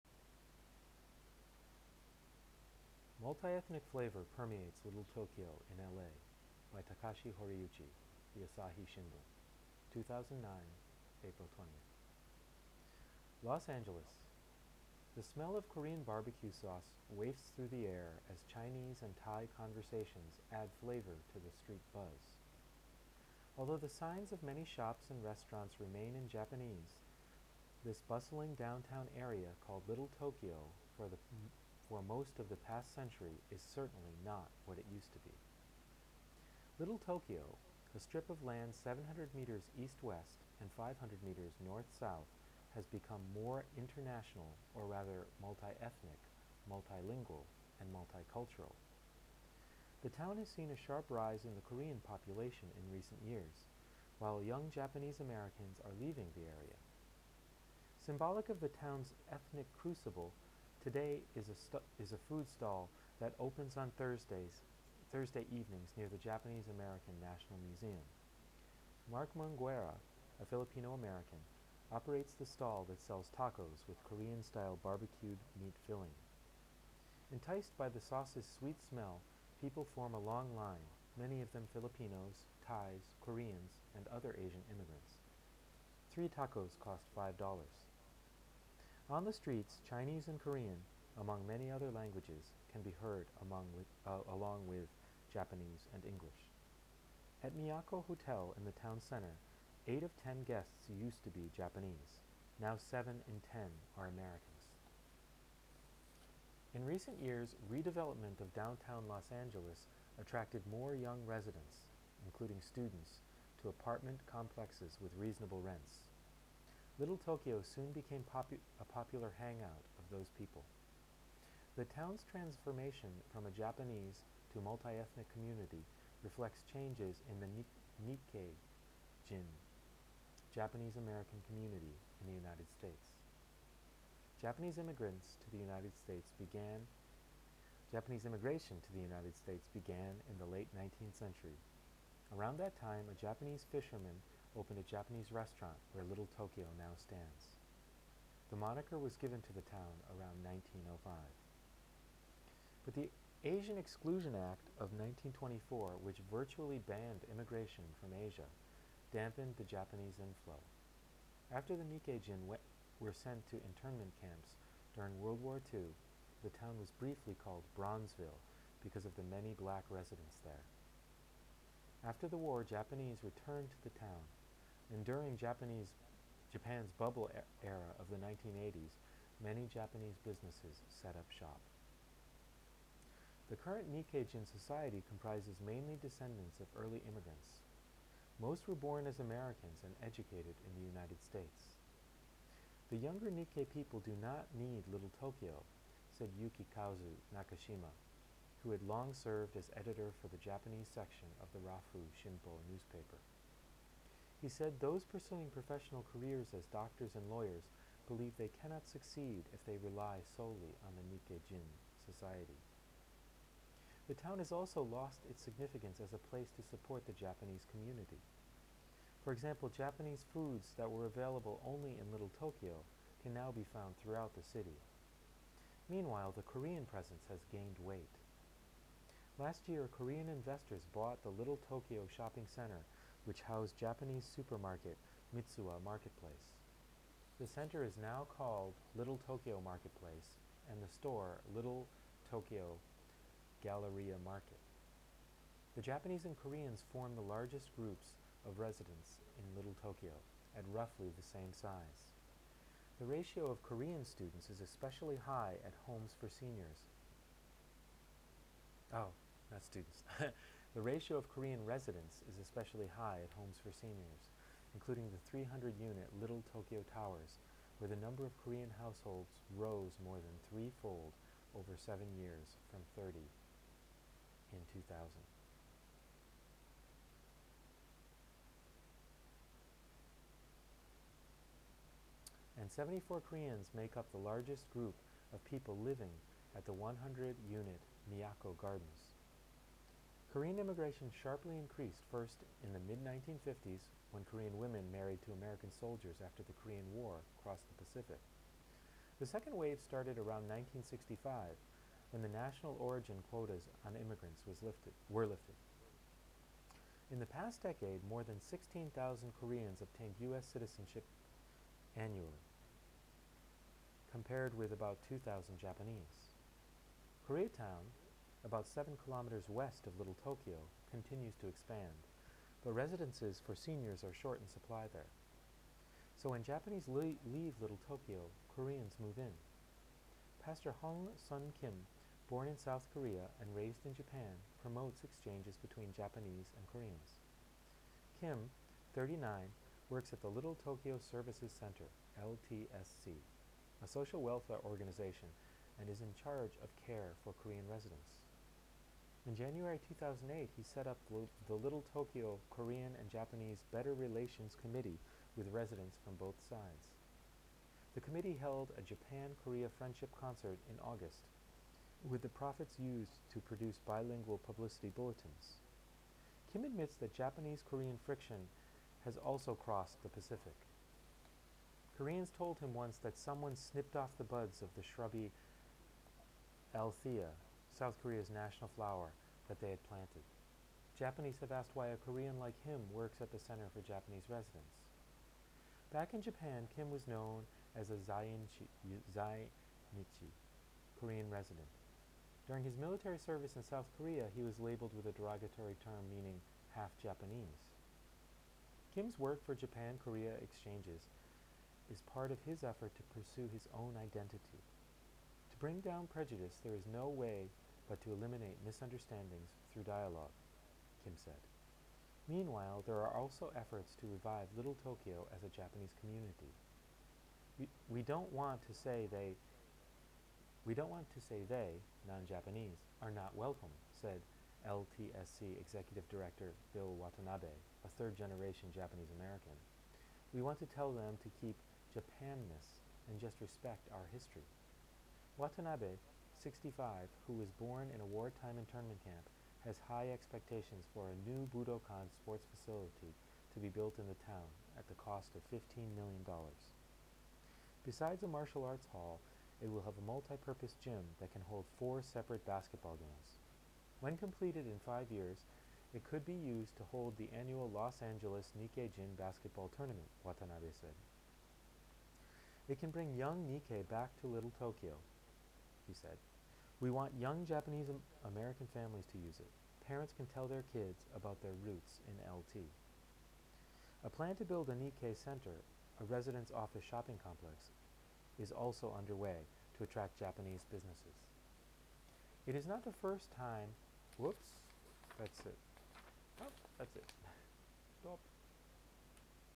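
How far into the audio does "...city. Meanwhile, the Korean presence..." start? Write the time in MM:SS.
03:44.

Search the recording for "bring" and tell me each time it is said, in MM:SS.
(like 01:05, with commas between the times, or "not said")
06:45, 07:42.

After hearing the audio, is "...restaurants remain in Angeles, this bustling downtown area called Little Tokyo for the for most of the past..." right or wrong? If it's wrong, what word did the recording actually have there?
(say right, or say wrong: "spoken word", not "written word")
wrong: "Japanese", not "Angeles".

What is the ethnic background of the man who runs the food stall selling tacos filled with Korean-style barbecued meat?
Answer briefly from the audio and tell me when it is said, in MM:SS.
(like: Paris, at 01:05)
Filipino American, at 01:10.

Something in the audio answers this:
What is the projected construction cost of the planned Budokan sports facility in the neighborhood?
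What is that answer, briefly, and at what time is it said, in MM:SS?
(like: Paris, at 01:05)
$15 million, at 07:25.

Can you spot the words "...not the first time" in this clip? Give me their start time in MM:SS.
08:02.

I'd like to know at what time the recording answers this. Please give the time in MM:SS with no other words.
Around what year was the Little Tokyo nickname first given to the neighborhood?
02:30.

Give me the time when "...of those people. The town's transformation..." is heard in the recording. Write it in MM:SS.
01:59.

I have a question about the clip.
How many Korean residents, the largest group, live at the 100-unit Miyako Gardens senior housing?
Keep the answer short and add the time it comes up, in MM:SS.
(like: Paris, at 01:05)
74, at 04:42.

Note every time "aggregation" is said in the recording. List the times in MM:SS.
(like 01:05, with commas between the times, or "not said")
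not said.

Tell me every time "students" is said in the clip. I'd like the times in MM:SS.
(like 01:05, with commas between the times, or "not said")
01:52, 04:14, 04:19.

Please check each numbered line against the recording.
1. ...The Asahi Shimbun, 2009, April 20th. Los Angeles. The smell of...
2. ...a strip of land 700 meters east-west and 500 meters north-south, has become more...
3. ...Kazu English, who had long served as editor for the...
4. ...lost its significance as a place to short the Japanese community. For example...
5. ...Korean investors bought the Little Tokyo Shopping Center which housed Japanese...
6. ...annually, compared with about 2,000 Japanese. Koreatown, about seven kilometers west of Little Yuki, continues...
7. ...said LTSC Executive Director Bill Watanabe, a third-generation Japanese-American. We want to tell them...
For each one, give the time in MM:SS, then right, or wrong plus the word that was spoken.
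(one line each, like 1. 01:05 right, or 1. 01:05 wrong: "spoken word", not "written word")
1. 00:08 right
2. 00:37 right
3. 03:16 wrong: "Nakashima", not "English"
4. 03:34 wrong: "support", not "short"
5. 03:49 right
6. 05:11 wrong: "Tokyo", not "Yuki"
7. 07:03 right.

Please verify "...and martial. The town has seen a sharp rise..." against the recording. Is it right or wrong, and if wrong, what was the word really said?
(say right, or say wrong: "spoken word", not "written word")
wrong: "multicultural", not "martial".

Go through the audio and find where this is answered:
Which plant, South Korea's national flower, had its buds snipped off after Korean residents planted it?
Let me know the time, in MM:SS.
06:16.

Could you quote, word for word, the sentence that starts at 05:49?
In January 2008, he set up the Little Tokyo Korean and Japanese Better Relations Committee with residents from both sides.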